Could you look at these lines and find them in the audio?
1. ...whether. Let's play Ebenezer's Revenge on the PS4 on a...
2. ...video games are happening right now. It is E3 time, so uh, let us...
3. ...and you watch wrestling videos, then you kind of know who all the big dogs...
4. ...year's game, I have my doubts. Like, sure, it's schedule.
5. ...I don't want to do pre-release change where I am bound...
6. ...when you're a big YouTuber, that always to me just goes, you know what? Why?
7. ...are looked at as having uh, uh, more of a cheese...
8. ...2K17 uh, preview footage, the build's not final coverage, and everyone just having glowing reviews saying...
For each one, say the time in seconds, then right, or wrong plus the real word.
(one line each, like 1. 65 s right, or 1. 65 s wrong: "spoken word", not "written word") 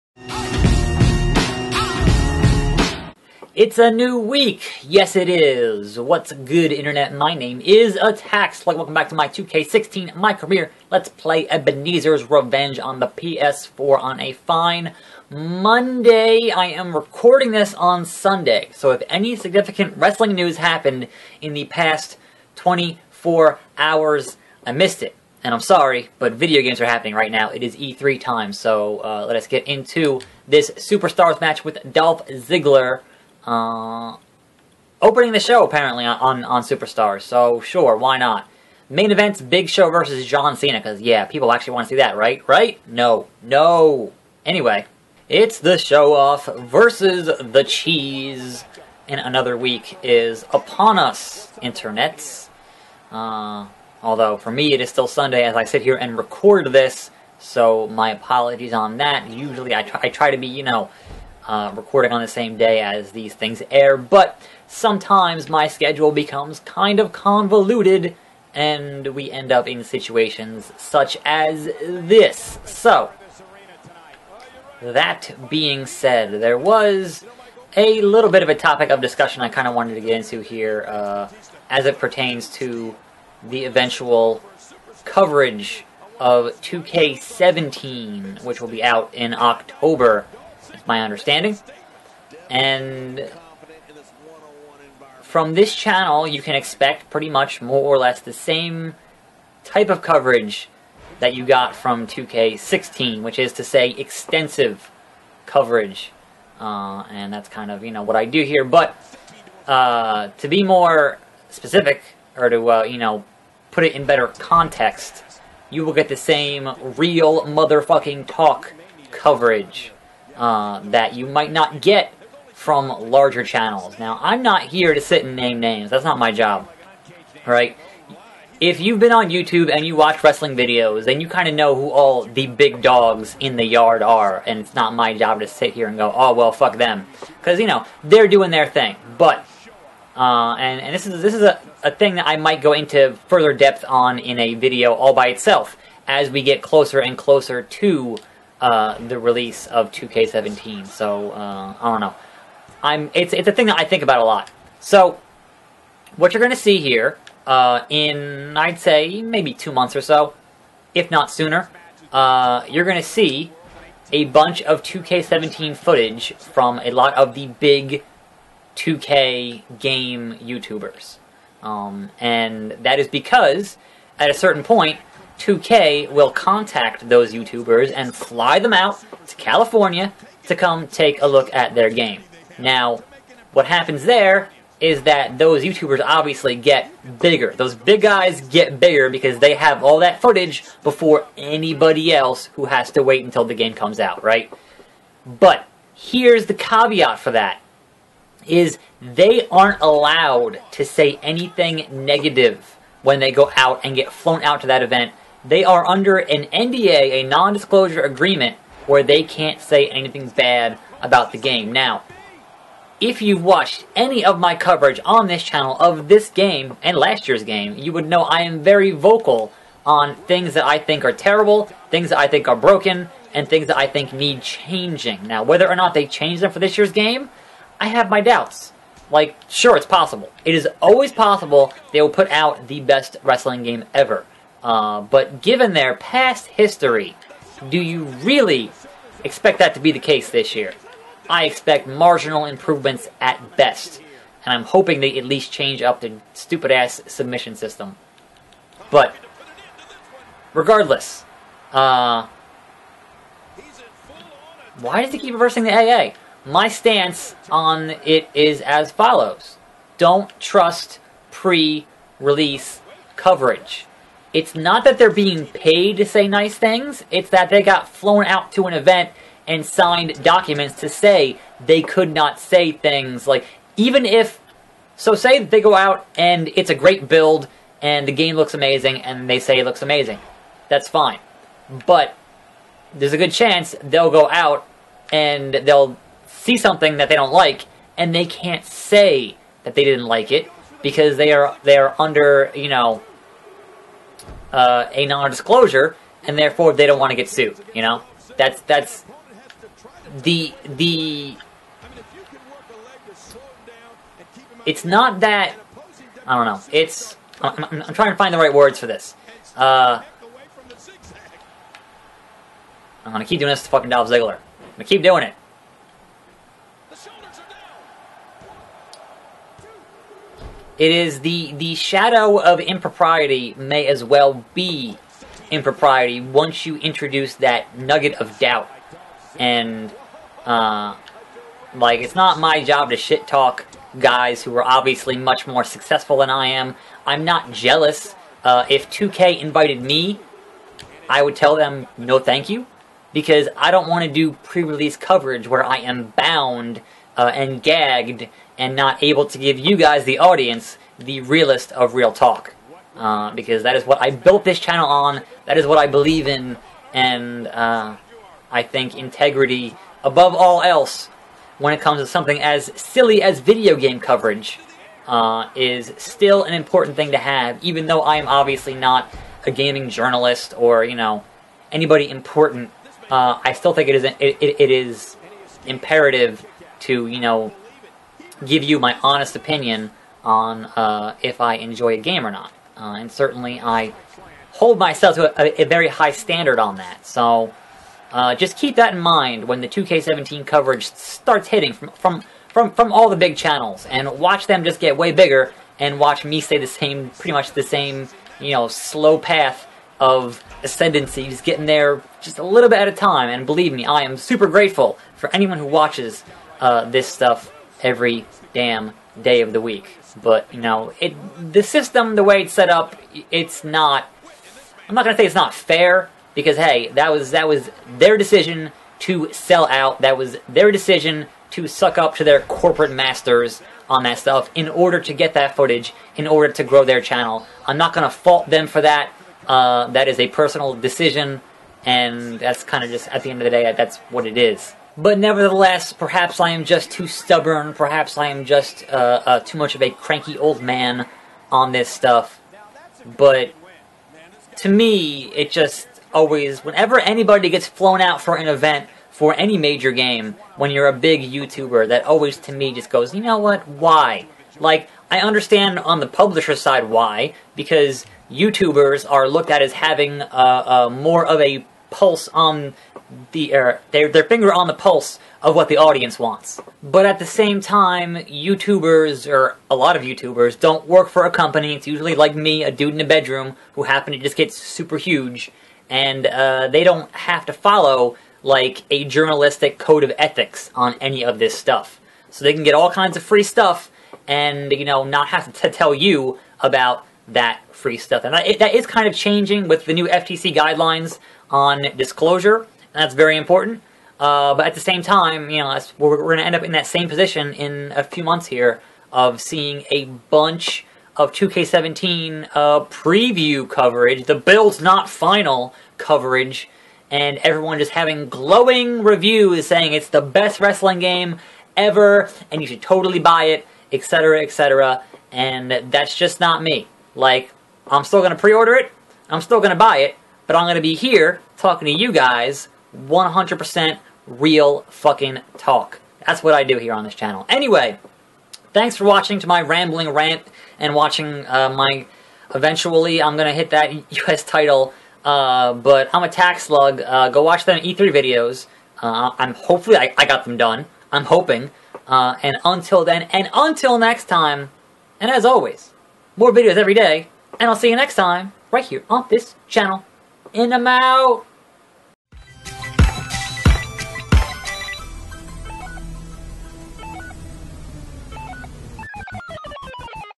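1. 10 s wrong: "career", not "whether"
2. 26 s right
3. 129 s right
4. 226 s wrong: "possible", not "schedule"
5. 343 s wrong: "coverage", not "change"
6. 450 s right
7. 459 s wrong: "pulse", not "cheese"
8. 501 s wrong: "coverage", not "footage".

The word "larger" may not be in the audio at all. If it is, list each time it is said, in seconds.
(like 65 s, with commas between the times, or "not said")
123 s.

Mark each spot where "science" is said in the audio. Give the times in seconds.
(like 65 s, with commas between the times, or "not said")
not said.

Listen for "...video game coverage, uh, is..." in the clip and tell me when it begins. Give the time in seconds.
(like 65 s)
363 s.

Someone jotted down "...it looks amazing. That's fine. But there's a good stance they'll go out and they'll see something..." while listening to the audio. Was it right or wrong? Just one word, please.
wrong.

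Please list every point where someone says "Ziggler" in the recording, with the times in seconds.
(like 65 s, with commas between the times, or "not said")
32 s, 314 s.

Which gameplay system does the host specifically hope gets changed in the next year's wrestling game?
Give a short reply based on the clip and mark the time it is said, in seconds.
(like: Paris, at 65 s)
submission system, at 247 s.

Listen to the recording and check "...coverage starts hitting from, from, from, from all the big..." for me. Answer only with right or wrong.
right.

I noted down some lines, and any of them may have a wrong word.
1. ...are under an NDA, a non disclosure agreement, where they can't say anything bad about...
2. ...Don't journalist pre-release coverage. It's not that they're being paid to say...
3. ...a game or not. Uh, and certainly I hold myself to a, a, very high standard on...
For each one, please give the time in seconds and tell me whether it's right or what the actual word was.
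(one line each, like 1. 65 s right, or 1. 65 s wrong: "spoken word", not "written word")
1. 205 s right
2. 259 s wrong: "trust", not "journalist"
3. 381 s right.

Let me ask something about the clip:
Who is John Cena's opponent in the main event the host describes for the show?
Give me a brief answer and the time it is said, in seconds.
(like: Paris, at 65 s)
Big Show, at 39 s.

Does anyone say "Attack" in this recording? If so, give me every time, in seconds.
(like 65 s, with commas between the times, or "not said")
7 s, 536 s.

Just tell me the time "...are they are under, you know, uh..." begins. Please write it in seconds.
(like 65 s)
291 s.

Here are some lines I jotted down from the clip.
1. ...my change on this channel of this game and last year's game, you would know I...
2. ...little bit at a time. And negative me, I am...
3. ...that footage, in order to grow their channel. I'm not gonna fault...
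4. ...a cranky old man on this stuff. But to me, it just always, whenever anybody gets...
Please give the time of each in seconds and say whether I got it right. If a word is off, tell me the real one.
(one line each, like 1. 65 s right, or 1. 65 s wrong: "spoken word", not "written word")
1. 214 s wrong: "coverage", not "change"
2. 402 s wrong: "believe", not "negative"
3. 425 s right
4. 439 s right.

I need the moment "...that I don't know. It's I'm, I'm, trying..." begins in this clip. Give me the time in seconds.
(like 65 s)
305 s.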